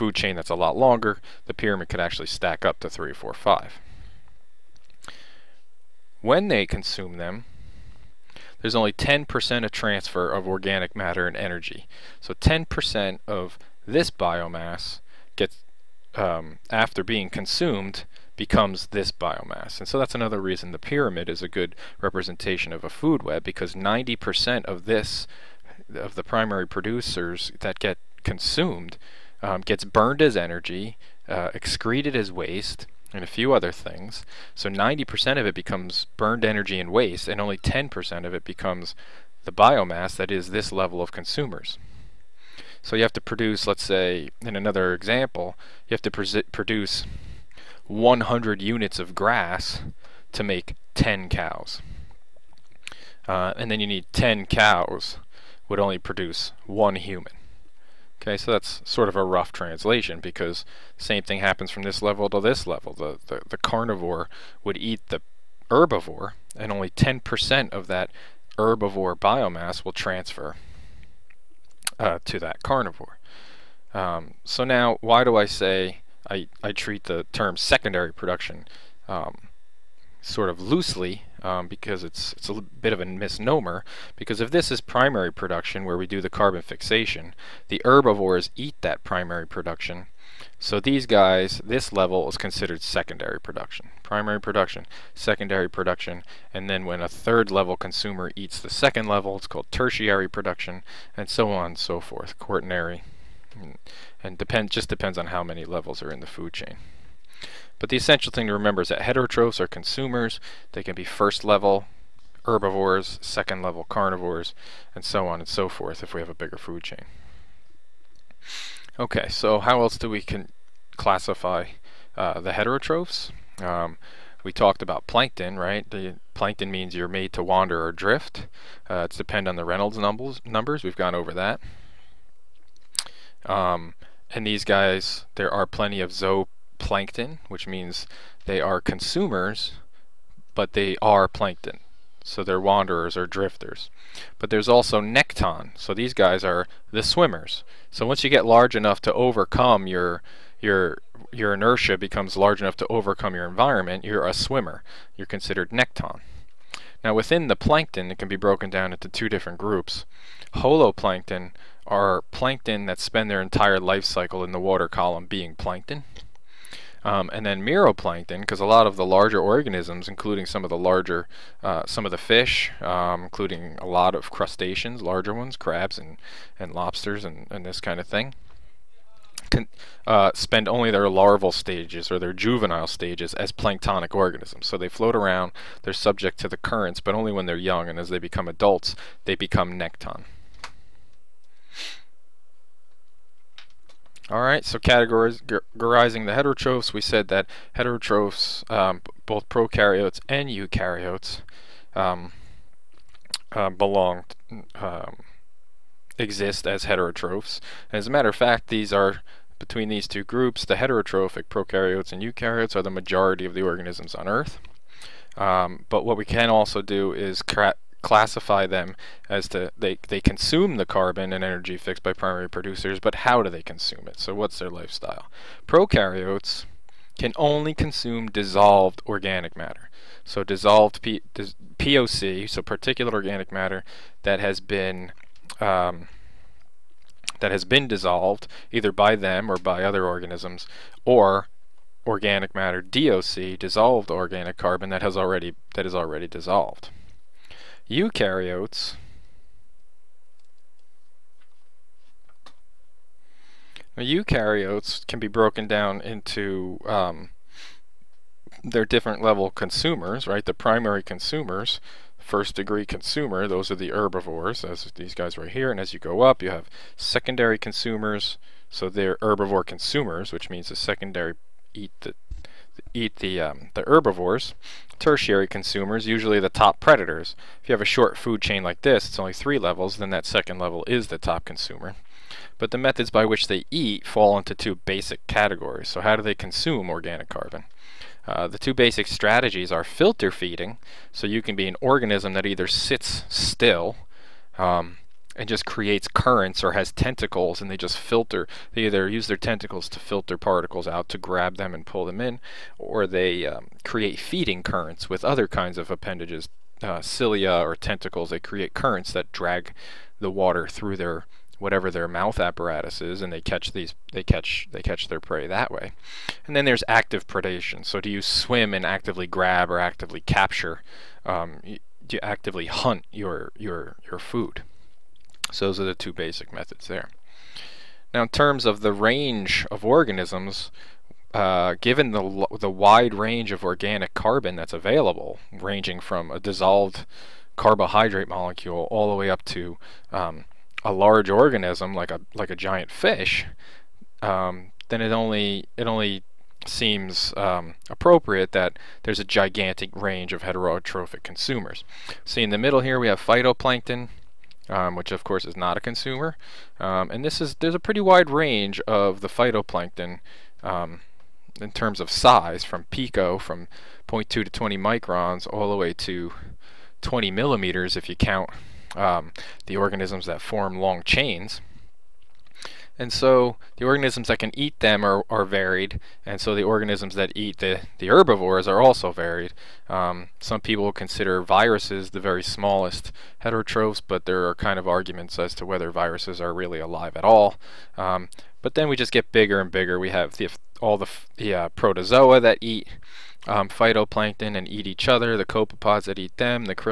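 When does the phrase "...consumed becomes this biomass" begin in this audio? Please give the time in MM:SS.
00:17.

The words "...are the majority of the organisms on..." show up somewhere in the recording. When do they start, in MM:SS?
03:32.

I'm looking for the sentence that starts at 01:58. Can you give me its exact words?
Okay, so how else do we can classify uh, the heterotrophs?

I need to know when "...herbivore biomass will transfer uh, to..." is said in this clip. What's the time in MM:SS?
01:08.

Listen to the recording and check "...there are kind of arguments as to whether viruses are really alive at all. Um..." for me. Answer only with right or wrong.
right.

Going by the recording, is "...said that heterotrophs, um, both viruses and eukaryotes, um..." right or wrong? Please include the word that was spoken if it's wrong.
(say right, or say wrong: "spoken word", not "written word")
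wrong: "prokaryotes", not "viruses".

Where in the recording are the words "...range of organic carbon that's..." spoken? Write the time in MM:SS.
05:33.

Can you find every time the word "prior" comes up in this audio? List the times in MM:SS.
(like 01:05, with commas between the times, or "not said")
not said.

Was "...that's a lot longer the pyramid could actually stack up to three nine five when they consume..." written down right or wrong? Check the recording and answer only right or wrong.
wrong.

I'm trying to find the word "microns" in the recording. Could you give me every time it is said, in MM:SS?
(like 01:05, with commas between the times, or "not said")
06:04.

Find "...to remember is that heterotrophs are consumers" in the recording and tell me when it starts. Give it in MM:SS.
01:48.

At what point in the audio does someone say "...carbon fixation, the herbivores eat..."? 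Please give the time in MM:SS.
01:26.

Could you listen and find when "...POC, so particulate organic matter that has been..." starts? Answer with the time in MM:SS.
03:51.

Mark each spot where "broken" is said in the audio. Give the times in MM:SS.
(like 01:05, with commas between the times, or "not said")
02:38, 04:15.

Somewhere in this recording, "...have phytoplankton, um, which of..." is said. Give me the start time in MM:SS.
05:53.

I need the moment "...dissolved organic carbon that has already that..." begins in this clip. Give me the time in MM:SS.
04:03.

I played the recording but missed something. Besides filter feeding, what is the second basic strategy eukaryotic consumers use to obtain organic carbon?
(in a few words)
active predation.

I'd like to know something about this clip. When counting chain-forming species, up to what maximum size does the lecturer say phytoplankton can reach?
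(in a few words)
20 millimeters.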